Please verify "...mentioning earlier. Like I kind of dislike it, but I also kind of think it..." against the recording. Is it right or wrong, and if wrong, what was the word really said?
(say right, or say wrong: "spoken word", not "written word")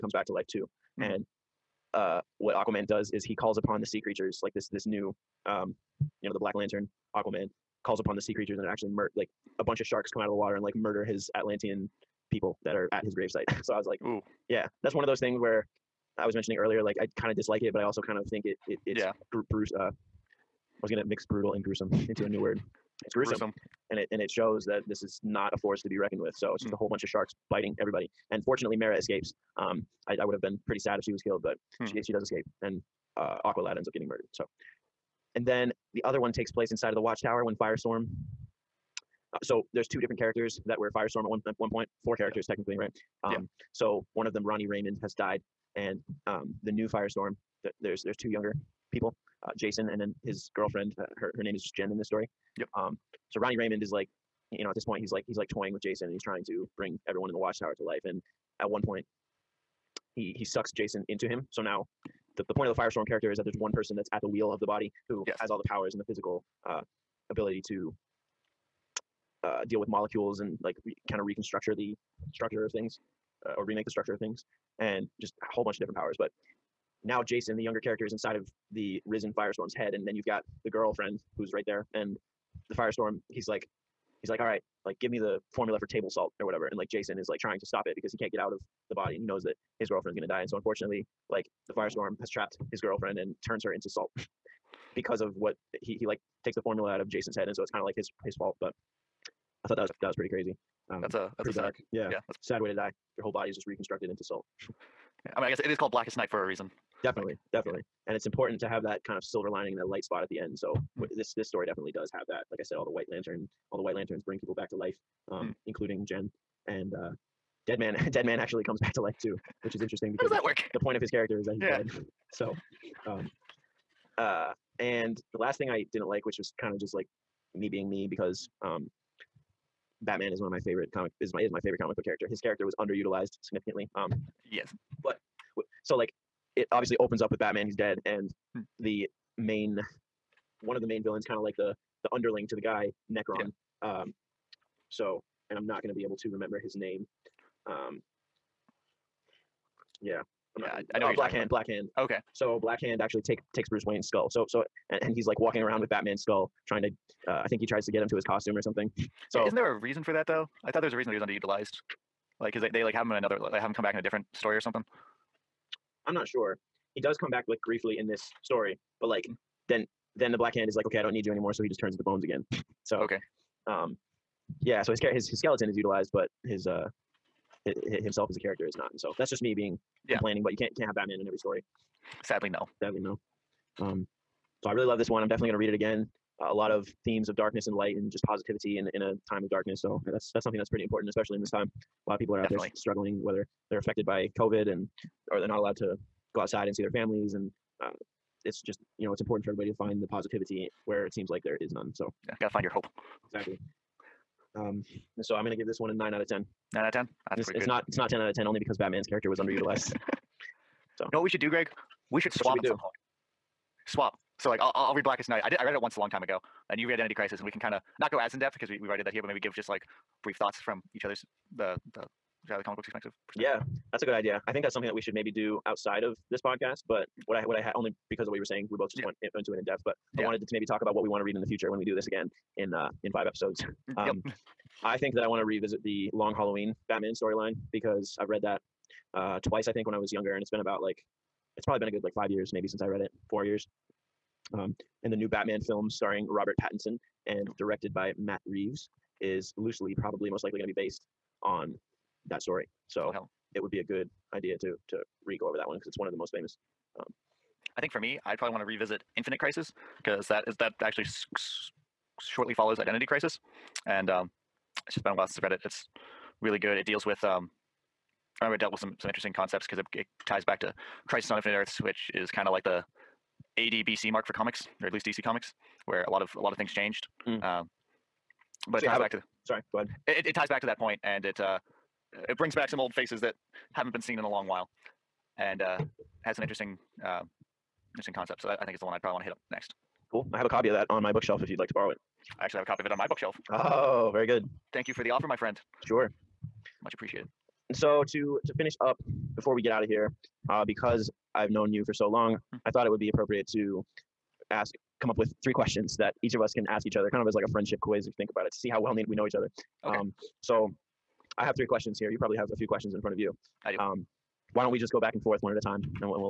right.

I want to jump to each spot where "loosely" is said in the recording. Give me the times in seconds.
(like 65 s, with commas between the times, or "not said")
249 s.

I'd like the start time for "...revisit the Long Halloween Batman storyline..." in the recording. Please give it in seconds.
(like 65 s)
235 s.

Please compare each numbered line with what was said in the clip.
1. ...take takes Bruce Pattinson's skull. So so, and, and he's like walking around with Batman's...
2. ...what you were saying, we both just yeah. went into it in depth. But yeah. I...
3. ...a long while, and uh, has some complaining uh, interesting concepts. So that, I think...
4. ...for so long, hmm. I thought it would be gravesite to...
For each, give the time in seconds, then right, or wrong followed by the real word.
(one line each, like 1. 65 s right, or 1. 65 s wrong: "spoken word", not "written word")
1. 153 s wrong: "Wayne", not "Pattinson"
2. 228 s right
3. 284 s wrong: "interesting", not "complaining"
4. 301 s wrong: "appropriate", not "gravesite".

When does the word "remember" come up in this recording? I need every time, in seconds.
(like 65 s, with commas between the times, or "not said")
146 s, 268 s.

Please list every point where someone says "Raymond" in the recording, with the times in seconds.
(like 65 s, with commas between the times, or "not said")
44 s, 53 s.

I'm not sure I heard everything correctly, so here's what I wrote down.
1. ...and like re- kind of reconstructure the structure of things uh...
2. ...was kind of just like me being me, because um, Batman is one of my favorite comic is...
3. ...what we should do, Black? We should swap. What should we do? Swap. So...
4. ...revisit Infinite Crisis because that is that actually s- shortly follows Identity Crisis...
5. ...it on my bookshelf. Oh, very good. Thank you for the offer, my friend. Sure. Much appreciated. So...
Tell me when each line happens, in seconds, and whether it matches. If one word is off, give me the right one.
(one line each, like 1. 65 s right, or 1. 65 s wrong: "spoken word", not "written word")
1. 70 s right
2. 126 s right
3. 211 s wrong: "Greg", not "Black"
4. 258 s right
5. 292 s right.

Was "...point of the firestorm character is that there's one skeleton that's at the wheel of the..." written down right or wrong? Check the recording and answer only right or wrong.
wrong.